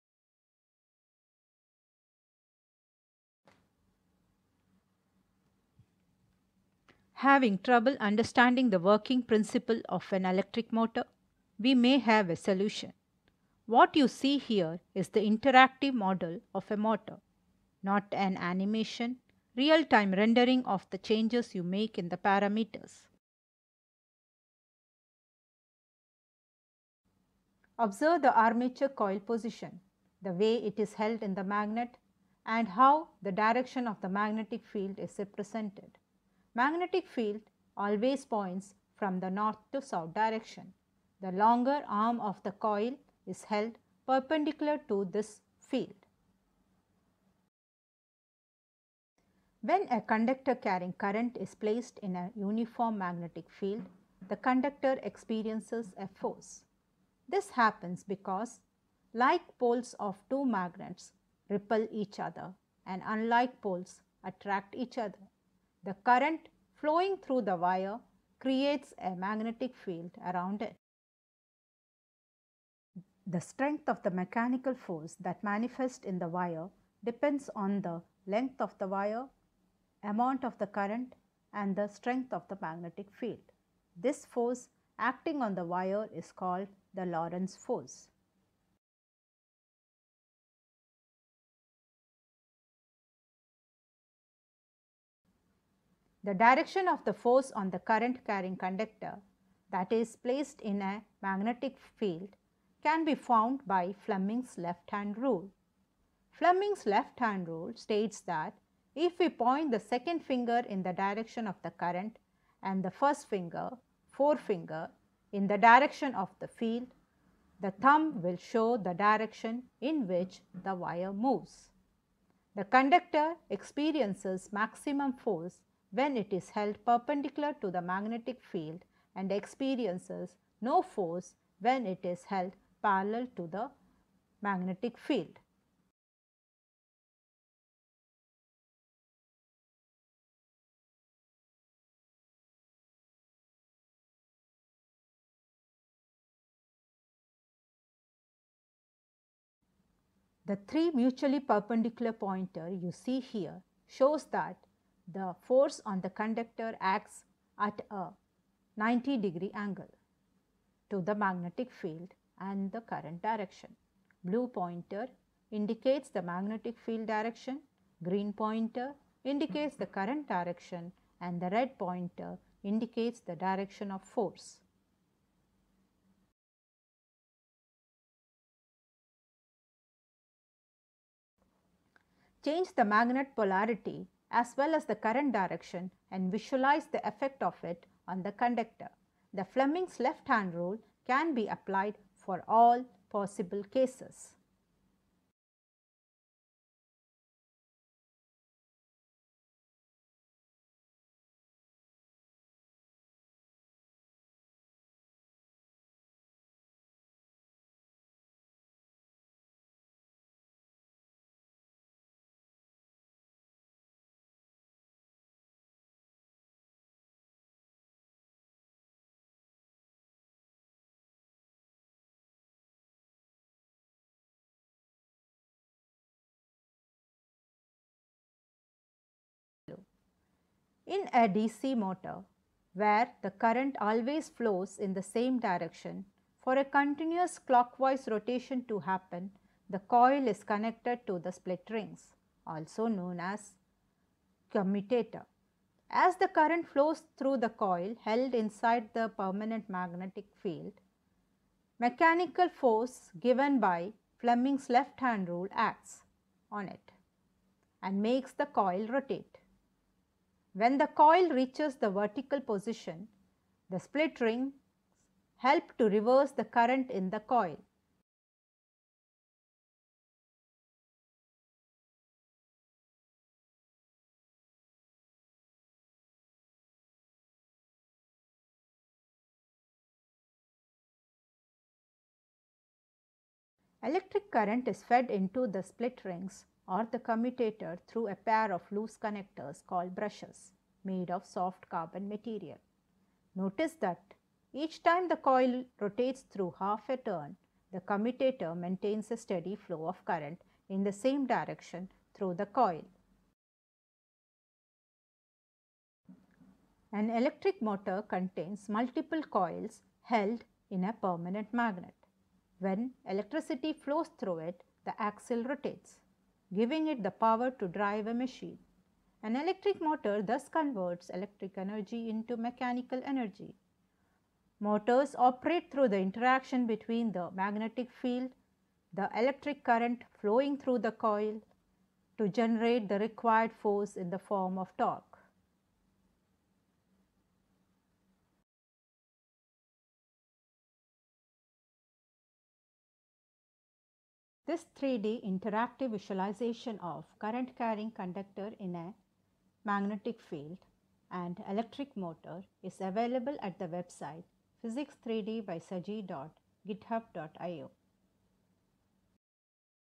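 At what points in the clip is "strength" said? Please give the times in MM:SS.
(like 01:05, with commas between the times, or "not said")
01:13, 01:21.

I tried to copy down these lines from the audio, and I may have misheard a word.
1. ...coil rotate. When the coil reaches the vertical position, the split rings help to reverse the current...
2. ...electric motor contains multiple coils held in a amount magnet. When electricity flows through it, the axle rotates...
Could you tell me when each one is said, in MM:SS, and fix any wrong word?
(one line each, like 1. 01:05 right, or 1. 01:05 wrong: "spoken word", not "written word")
1. 04:18 right
2. 05:07 wrong: "permanent", not "amount".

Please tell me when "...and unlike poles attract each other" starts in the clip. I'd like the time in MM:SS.
01:02.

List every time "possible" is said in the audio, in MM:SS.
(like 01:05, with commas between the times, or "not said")
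03:13.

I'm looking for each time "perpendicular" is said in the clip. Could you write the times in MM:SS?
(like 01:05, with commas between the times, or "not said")
00:44, 02:06, 02:31.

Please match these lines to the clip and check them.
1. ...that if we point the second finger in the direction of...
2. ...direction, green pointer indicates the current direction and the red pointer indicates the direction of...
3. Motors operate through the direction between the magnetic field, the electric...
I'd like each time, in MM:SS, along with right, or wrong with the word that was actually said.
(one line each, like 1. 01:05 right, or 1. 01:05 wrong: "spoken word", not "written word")
1. 01:48 right
2. 02:47 right
3. 05:24 wrong: "interaction", not "direction".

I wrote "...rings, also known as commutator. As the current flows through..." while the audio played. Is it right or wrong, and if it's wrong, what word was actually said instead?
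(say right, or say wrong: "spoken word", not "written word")
right.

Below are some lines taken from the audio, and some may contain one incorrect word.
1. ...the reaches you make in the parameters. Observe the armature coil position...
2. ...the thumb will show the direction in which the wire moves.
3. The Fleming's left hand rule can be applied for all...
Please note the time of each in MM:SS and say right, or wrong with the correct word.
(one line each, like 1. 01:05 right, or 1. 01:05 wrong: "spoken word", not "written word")
1. 00:20 wrong: "changes", not "reaches"
2. 01:57 right
3. 03:09 right.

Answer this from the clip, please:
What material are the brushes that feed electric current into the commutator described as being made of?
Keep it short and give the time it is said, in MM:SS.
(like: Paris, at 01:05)
Soft carbon, at 04:51.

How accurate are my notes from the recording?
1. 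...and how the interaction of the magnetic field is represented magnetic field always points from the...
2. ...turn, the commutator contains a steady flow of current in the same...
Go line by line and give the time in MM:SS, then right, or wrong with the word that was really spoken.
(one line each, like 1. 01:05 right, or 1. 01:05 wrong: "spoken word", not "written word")
1. 00:32 wrong: "direction", not "interaction"
2. 04:56 wrong: "maintains", not "contains".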